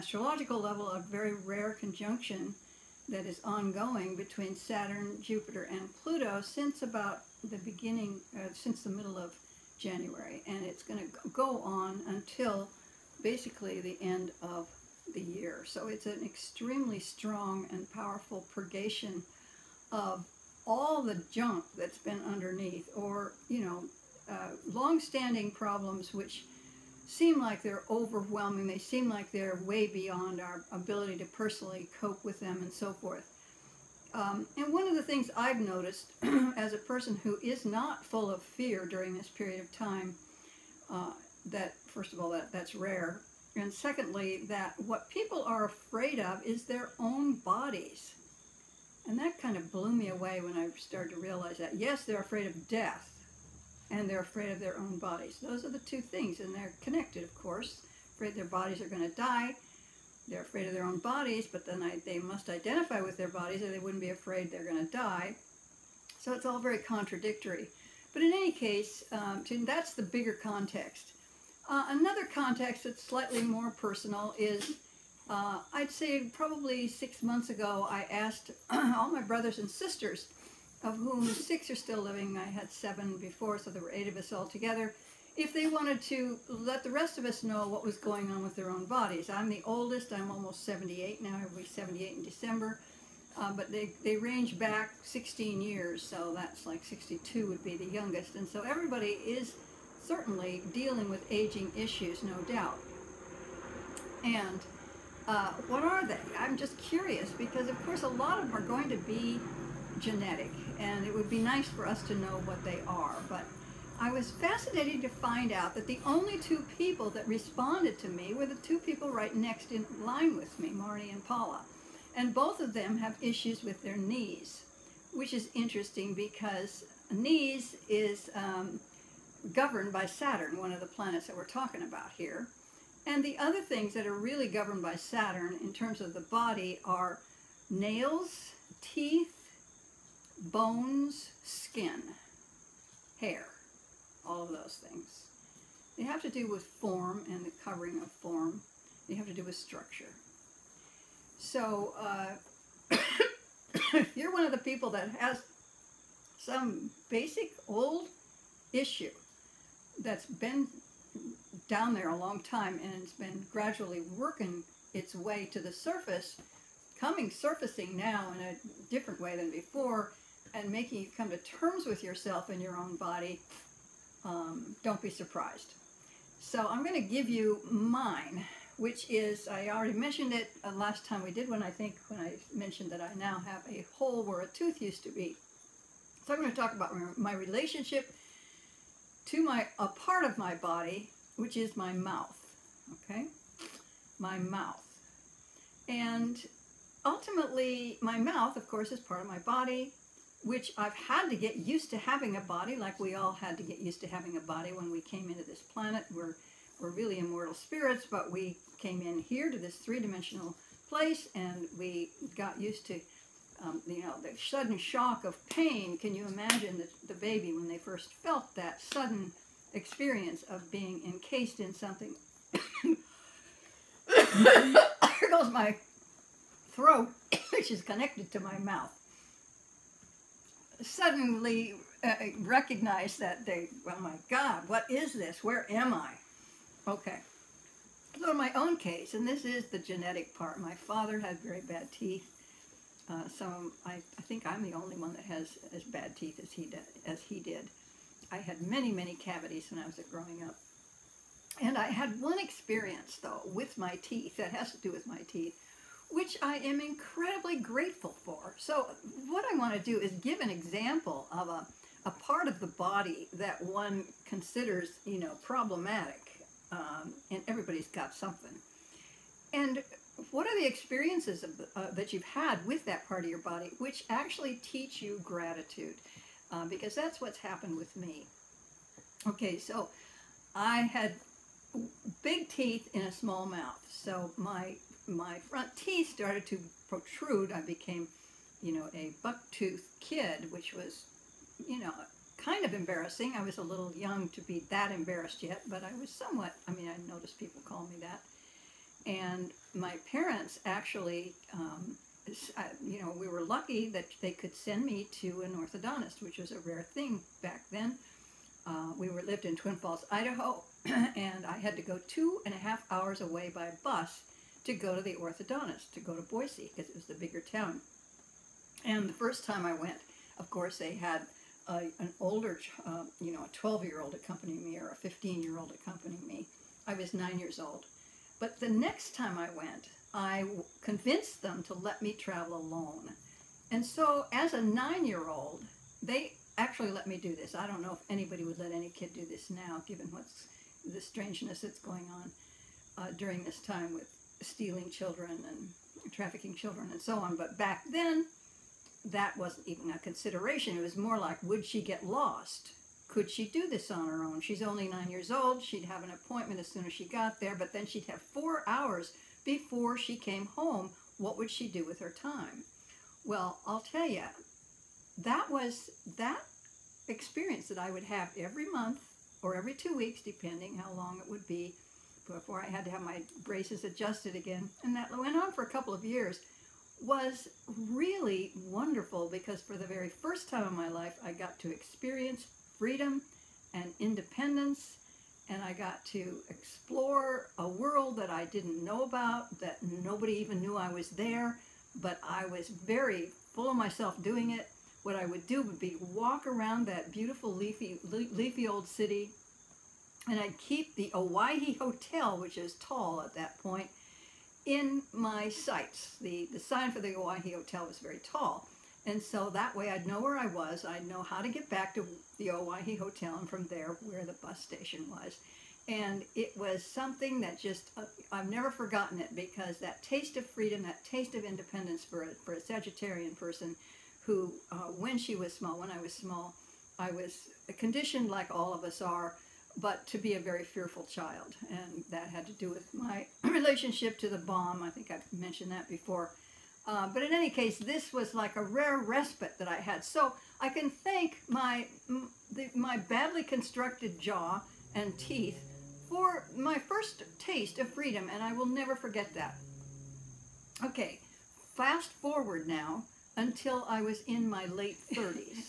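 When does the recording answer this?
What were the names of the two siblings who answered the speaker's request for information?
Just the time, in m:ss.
2:00.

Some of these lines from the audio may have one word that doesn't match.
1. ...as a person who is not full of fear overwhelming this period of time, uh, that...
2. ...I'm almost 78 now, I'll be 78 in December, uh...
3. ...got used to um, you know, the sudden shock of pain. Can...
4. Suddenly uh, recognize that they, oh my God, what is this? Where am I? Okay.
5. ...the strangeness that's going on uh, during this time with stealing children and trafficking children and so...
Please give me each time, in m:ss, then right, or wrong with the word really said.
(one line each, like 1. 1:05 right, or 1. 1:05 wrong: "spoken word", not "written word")
1. 0:36 wrong: "during", not "overwhelming"
2. 1:30 right
3. 3:32 right
4. 3:50 right
5. 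5:40 right.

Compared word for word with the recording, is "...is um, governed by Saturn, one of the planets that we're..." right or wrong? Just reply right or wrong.
right.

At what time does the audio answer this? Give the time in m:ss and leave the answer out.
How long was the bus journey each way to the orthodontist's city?
5:12.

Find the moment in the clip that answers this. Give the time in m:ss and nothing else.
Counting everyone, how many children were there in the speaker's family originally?
1:23.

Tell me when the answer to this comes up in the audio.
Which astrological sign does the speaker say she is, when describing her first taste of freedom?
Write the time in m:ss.
7:02.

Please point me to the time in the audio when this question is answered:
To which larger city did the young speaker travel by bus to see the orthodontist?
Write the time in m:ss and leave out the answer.
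5:16.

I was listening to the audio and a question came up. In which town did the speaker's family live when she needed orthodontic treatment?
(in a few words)
Twin Falls, Idaho.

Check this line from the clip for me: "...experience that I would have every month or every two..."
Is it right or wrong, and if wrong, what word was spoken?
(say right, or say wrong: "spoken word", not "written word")
right.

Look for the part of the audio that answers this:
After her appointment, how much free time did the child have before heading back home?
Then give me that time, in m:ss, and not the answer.
5:58.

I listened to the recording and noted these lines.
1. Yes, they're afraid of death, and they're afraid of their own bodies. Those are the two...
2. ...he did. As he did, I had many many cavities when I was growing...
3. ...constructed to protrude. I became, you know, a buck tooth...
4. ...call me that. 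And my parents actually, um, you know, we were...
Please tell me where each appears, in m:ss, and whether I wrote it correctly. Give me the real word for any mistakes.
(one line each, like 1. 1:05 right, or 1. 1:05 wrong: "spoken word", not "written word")
1. 0:51 right
2. 4:06 right
3. 4:46 wrong: "started", not "constructed"
4. 4:57 right.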